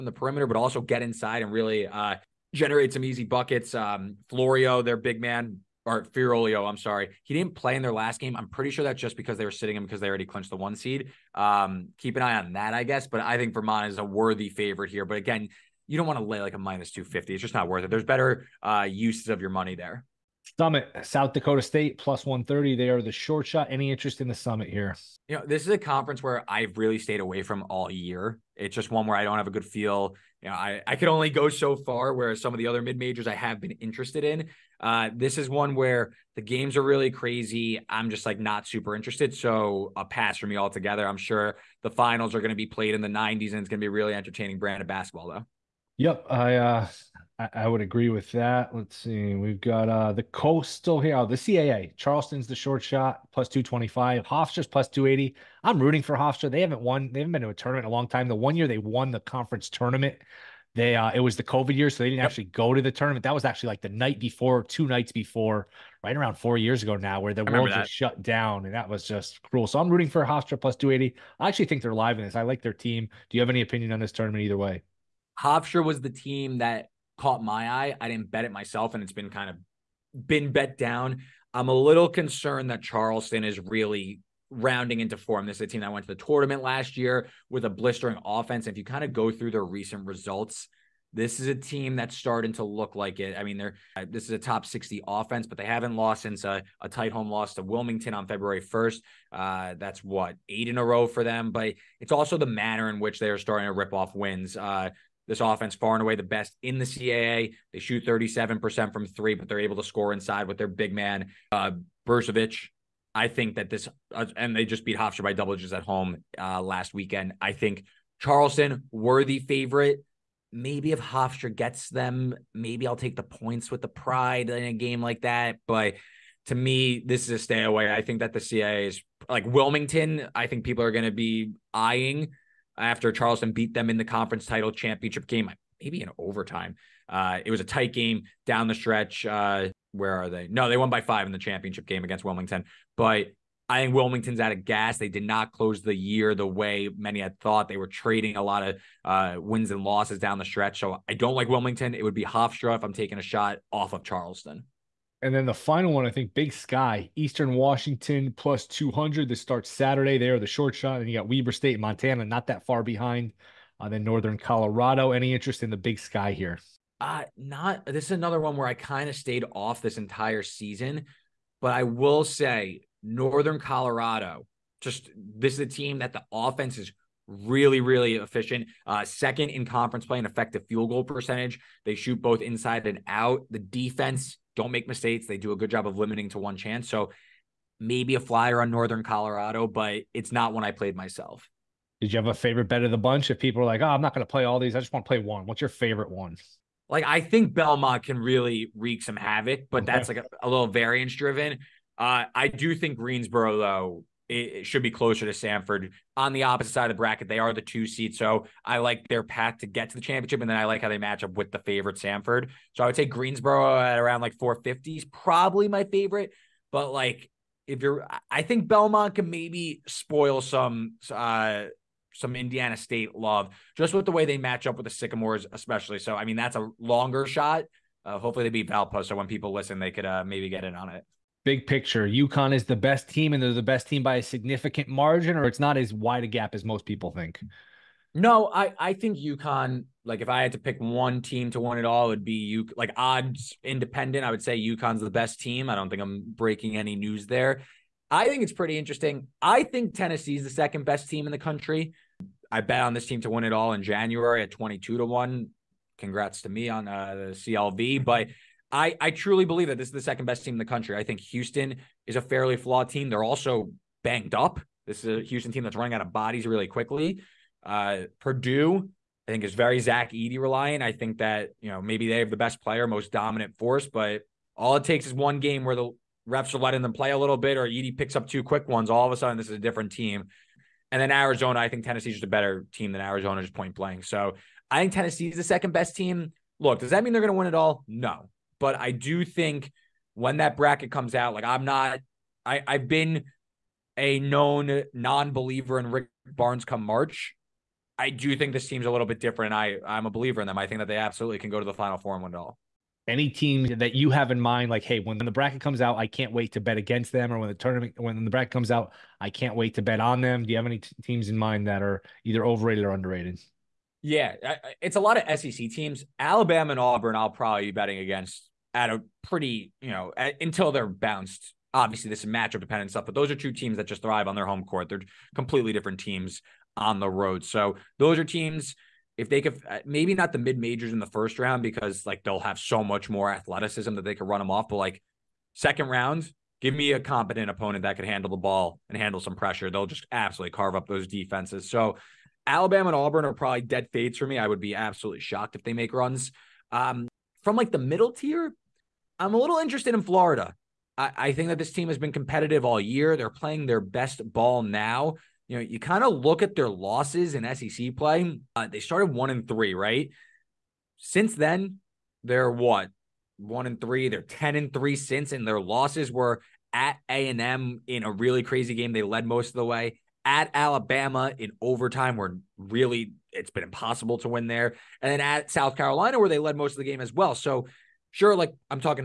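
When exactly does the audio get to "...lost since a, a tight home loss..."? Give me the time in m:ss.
1:35.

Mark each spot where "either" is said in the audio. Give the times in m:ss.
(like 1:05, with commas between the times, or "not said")
1:14, 5:12.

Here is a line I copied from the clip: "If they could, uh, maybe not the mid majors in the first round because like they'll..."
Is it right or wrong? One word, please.
right.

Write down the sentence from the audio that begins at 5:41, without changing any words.
So Alabama and Auburn are probably dead fates for me.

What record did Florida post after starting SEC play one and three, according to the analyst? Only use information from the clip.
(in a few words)
10 and 3.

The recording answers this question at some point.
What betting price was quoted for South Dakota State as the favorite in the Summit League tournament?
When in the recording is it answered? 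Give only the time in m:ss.
0:21.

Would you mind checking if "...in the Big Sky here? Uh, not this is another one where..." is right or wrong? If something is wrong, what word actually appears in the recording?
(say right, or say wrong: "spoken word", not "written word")
right.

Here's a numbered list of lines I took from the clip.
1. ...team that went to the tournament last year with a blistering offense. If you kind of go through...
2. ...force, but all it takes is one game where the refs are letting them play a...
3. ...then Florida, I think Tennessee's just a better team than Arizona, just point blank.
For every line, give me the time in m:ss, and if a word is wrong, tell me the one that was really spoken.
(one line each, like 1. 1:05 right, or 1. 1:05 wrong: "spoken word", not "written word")
1. 1:25 right
2. 4:33 right
3. 4:40 wrong: "Arizona", not "Florida".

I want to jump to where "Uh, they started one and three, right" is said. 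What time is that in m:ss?
5:58.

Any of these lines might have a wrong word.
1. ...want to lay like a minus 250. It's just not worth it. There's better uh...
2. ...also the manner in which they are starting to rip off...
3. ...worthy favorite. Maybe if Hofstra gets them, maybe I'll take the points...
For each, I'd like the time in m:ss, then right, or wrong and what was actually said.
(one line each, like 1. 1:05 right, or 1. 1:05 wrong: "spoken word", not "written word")
1. 0:16 right
2. 1:42 right
3. 1:58 right.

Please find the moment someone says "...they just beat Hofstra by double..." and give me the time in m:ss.
1:54.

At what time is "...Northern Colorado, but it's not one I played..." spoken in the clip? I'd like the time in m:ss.
3:08.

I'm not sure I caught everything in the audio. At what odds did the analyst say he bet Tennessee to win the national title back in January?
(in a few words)
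22 to 1.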